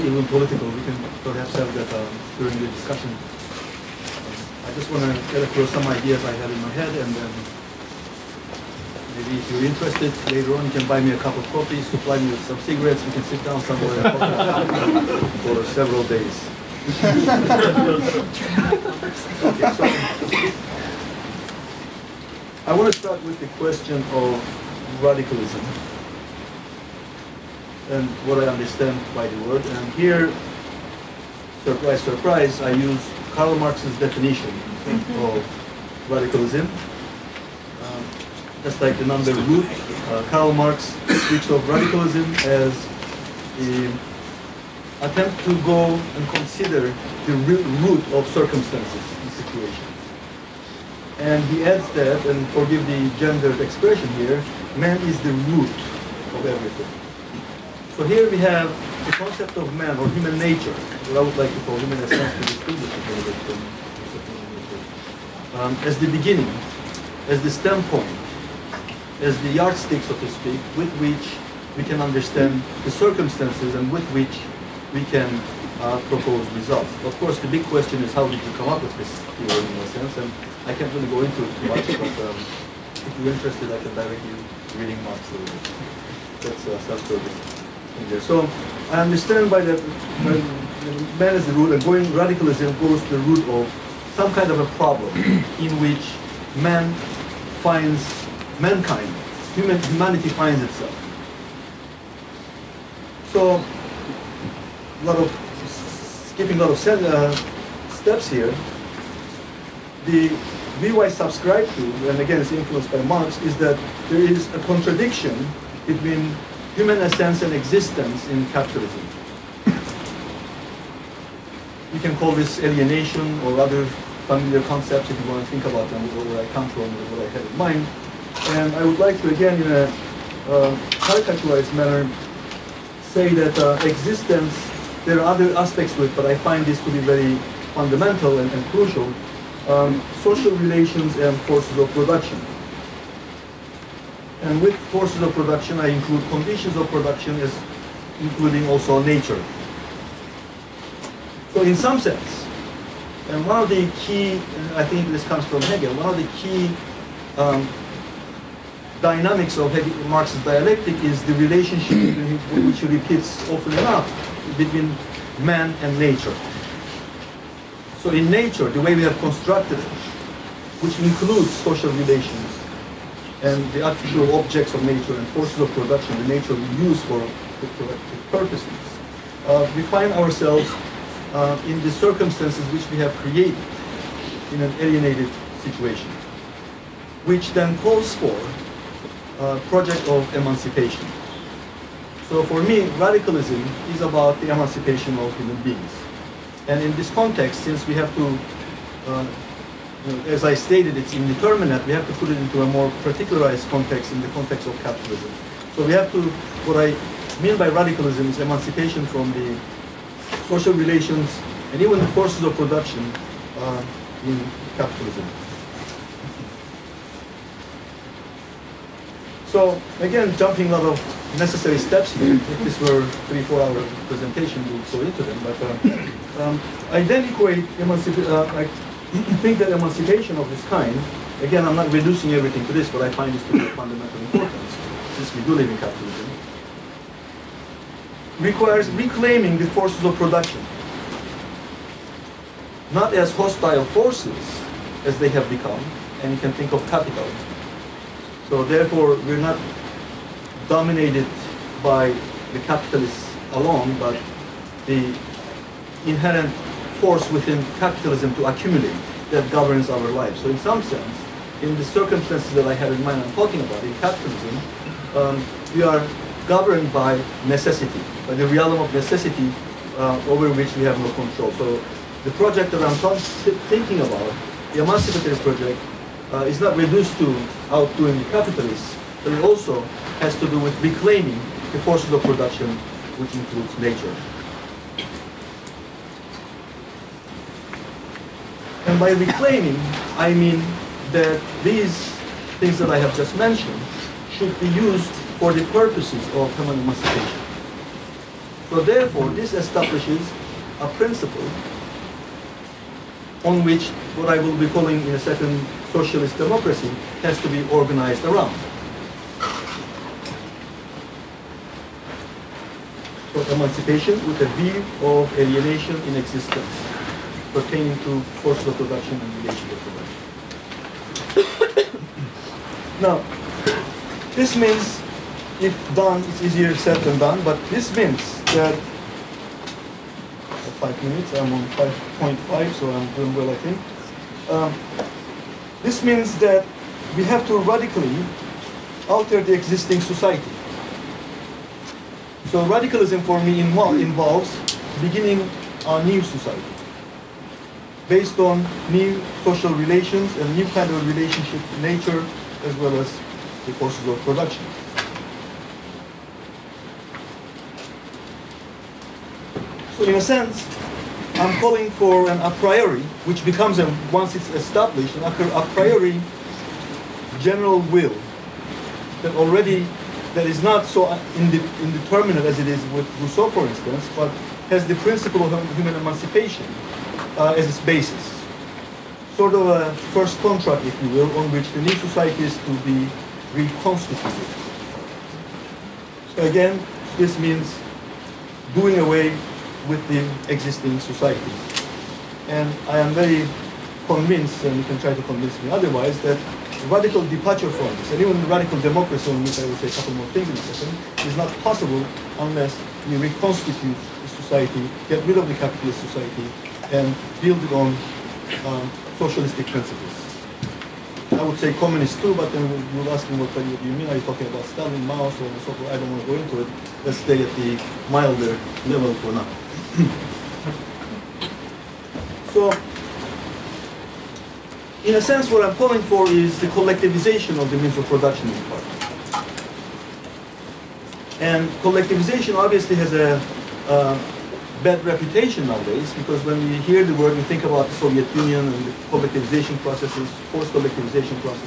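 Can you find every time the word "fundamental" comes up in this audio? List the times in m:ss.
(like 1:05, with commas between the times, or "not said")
2:17, 3:53.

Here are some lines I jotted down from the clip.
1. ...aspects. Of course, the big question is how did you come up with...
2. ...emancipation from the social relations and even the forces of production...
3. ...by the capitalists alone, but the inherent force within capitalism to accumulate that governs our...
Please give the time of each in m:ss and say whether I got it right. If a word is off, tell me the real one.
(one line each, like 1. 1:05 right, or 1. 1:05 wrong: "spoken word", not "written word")
1. 1:16 wrong: "results", not "aspects"
2. 3:28 right
3. 4:11 right.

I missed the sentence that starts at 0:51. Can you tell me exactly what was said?
And he adds that, and forgive the gendered expression here, man is the root of everything.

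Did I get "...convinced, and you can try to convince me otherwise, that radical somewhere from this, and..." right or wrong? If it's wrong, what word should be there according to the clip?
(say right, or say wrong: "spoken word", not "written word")
wrong: "departure", not "somewhere".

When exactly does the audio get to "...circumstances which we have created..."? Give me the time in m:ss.
3:01.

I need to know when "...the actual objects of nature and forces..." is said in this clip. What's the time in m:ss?
2:53.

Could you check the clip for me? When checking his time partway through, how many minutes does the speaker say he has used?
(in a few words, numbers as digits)
5.5.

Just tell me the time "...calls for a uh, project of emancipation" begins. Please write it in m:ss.
3:07.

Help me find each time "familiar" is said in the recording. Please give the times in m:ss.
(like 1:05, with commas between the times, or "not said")
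2:04.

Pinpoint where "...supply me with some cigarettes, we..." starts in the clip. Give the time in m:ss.
0:11.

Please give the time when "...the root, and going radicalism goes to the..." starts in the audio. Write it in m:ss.
1:31.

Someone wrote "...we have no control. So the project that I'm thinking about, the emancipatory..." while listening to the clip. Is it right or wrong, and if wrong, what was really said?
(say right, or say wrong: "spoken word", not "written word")
right.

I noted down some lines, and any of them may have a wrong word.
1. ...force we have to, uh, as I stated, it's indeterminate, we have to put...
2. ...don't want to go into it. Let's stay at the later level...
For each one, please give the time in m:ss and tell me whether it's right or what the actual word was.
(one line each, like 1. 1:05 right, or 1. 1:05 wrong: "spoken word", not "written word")
1. 3:17 wrong: "since", not "force"
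2. 6:55 wrong: "milder", not "later".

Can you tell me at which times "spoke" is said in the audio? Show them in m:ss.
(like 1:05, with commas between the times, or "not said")
not said.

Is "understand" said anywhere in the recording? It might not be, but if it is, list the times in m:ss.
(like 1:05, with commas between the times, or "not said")
0:28, 1:12, 1:29.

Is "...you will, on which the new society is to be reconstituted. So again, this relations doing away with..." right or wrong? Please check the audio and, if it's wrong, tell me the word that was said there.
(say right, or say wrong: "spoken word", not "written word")
wrong: "means", not "relations".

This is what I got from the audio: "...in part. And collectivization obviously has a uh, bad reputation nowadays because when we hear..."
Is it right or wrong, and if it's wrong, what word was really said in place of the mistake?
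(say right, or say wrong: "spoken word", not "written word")
right.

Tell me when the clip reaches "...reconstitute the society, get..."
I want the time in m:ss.
6:43.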